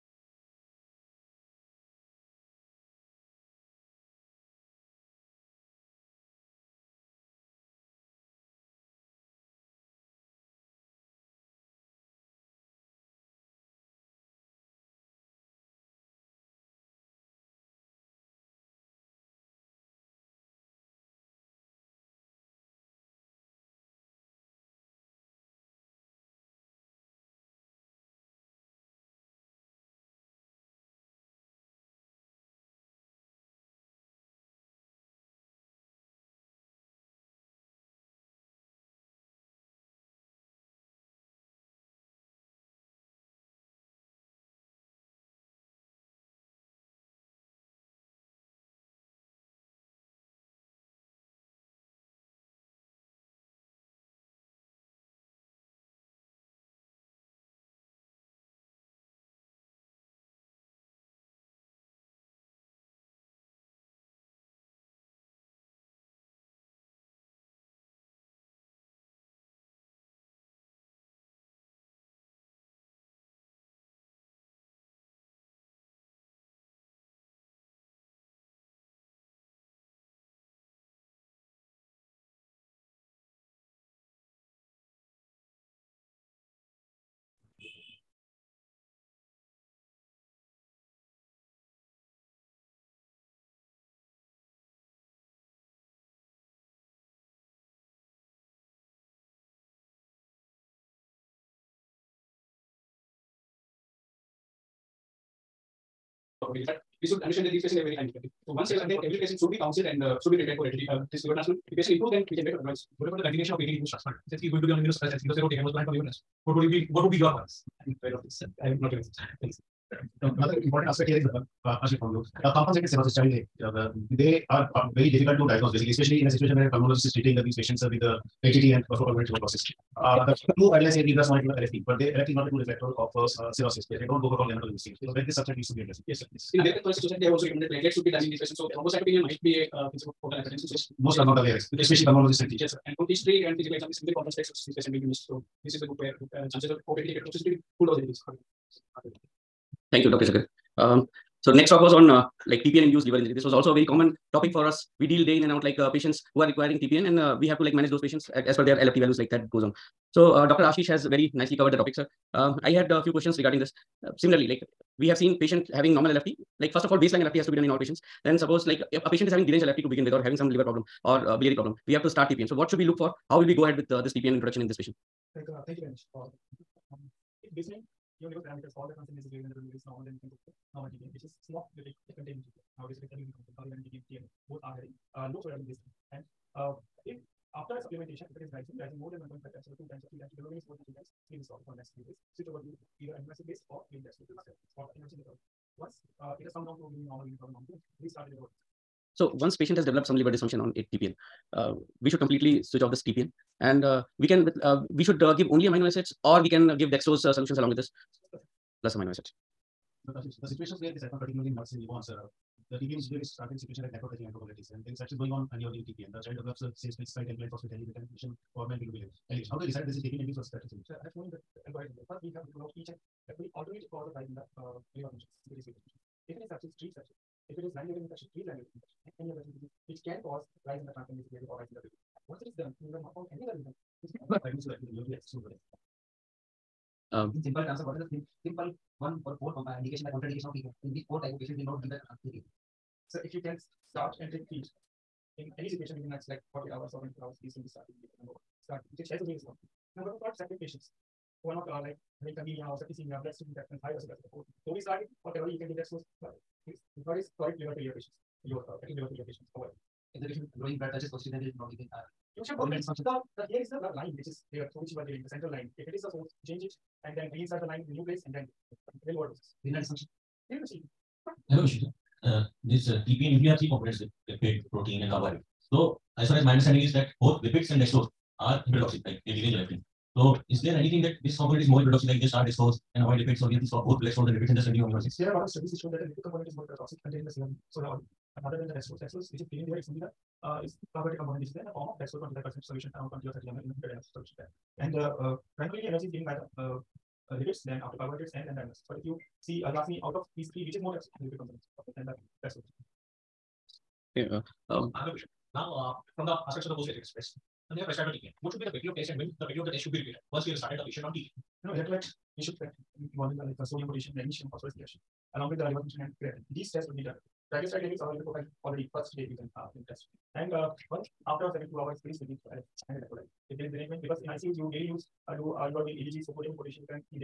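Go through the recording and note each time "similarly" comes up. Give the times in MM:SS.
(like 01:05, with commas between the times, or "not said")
02:44.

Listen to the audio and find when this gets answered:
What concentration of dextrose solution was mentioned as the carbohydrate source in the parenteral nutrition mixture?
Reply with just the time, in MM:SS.
04:51.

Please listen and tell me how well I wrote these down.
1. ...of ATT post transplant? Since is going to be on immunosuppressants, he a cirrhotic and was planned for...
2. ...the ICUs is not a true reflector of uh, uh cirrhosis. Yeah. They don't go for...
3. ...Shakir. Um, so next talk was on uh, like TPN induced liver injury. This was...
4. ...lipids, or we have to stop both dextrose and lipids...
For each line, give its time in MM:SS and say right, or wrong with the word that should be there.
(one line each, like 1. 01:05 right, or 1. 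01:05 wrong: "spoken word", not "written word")
1. 01:53 right
2. 02:11 wrong: "LFT", not "ICUs"
3. 02:30 right
4. 04:43 right.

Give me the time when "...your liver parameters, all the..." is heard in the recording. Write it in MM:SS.
02:58.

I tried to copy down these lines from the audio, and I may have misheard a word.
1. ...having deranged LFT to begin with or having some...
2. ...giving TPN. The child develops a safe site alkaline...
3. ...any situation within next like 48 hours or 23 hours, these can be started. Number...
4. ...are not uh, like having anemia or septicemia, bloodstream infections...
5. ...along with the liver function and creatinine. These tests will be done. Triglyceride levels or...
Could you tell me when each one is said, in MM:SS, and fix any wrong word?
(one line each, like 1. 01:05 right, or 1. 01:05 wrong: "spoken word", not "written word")
1. 02:49 right
2. 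03:35 right
3. 04:05 wrong: "24", not "23"
4. 04:11 right
5. 05:15 right.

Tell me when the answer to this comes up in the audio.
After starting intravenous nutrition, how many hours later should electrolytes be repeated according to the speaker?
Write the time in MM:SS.
05:21.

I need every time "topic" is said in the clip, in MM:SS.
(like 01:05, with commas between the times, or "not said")
02:34, 02:41.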